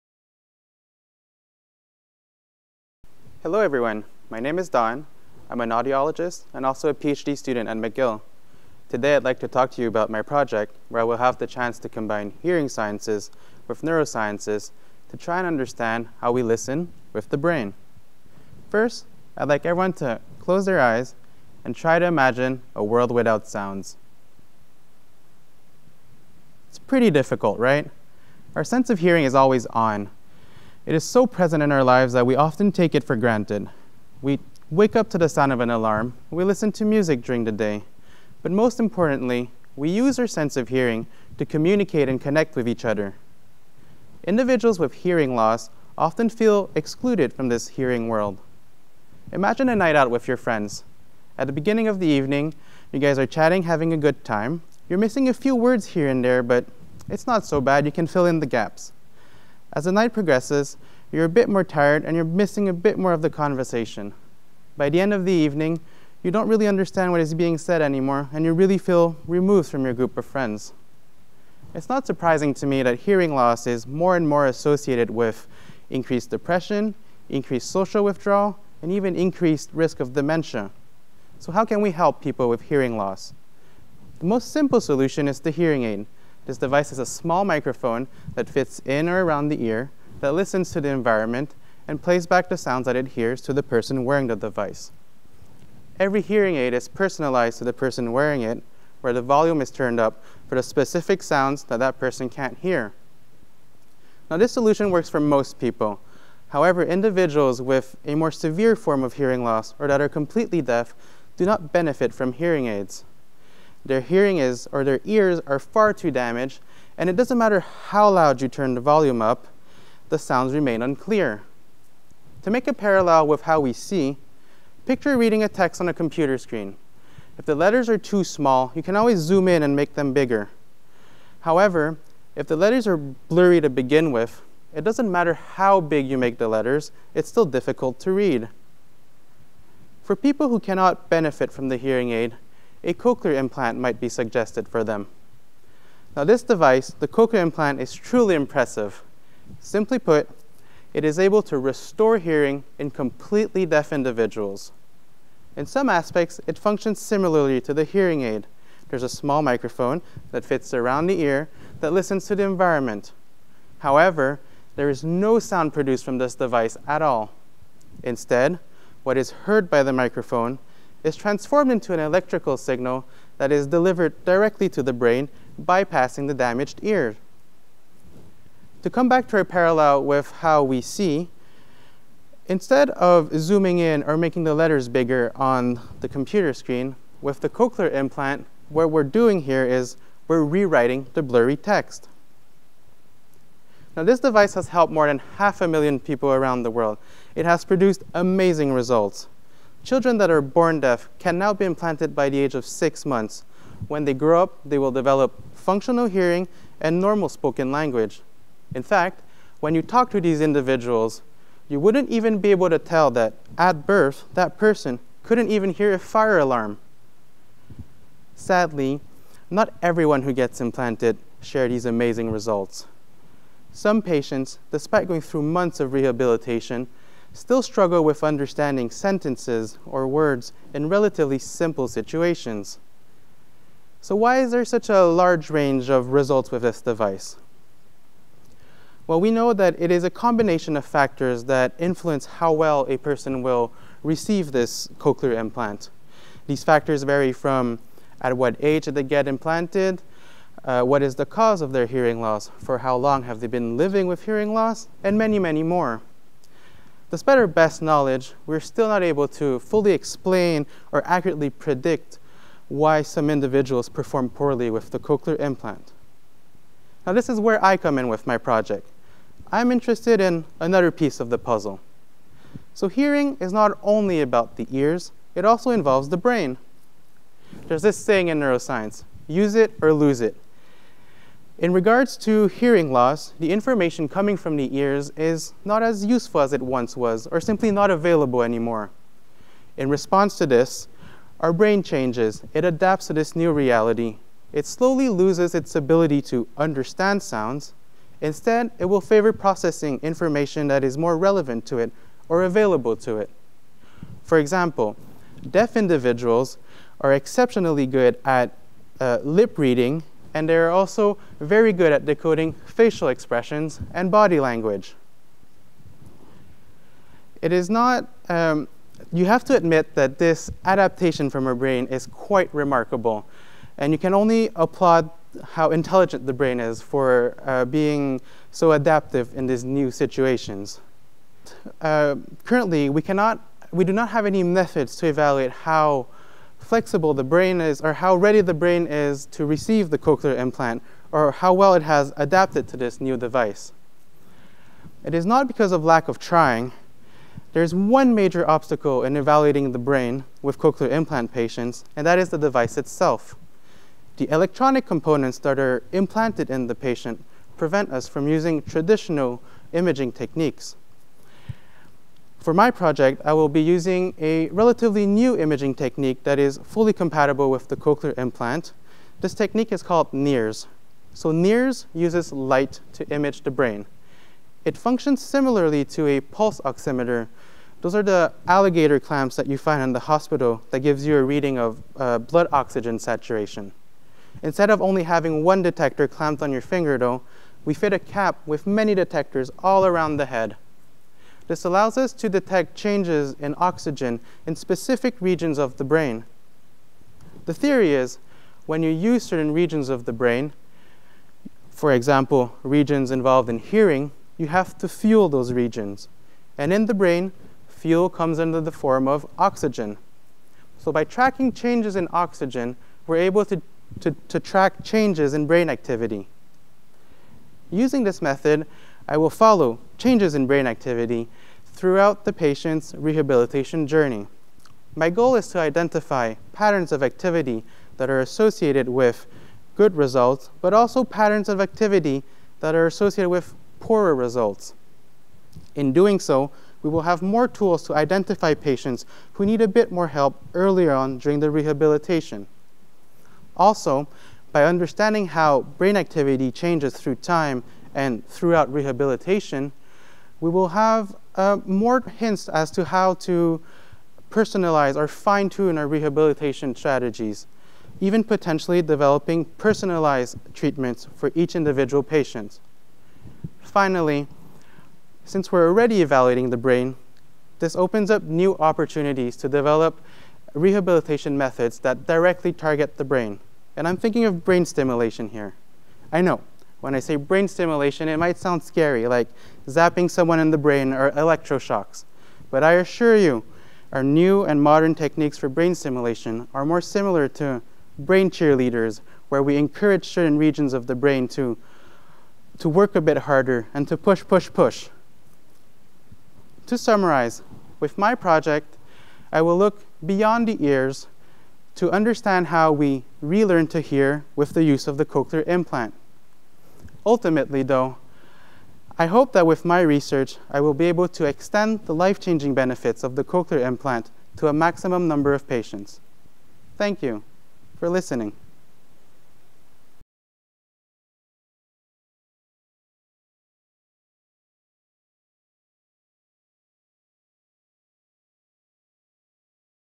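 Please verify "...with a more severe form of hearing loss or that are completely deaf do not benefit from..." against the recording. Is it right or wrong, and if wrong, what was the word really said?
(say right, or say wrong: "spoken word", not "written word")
right.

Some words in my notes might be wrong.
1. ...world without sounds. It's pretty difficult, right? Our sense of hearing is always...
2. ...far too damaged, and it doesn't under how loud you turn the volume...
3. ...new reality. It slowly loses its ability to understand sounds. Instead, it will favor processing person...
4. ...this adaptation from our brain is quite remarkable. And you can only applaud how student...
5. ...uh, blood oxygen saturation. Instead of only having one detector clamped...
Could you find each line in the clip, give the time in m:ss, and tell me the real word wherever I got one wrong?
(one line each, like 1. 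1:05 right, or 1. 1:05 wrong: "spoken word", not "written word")
1. 0:22 right
2. 1:55 wrong: "matter", not "under"
3. 4:53 wrong: "information", not "person"
4. 5:20 wrong: "intelligent", not "student"
5. 6:21 right.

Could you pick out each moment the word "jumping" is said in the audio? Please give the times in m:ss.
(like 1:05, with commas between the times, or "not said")
not said.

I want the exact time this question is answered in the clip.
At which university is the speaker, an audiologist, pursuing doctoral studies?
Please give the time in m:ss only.
0:07.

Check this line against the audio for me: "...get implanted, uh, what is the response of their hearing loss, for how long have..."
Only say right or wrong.
wrong.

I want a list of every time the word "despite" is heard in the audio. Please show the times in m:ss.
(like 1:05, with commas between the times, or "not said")
3:44, 4:17.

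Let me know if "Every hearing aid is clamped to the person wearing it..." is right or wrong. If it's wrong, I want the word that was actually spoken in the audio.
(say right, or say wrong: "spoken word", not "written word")
wrong: "personalized", not "clamped".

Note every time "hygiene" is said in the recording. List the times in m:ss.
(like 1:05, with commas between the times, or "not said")
not said.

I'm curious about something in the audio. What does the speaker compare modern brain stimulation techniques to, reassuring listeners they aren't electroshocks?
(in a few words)
brain cheerleaders.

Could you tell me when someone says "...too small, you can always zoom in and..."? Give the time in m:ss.
2:07.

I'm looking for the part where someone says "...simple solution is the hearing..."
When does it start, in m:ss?
1:24.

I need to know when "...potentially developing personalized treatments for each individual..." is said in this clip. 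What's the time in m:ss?
7:38.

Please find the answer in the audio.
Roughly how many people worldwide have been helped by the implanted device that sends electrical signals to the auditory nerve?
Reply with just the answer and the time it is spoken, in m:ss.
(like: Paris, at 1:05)
more than half a million, at 3:14.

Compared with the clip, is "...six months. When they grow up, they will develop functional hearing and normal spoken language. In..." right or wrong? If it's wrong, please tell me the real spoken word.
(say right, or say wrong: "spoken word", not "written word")
right.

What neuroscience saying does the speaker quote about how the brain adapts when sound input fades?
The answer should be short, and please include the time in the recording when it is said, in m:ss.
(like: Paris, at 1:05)
use it or lose it, at 4:39.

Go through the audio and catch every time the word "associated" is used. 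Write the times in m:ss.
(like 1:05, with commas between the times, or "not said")
1:14, 7:08, 7:12.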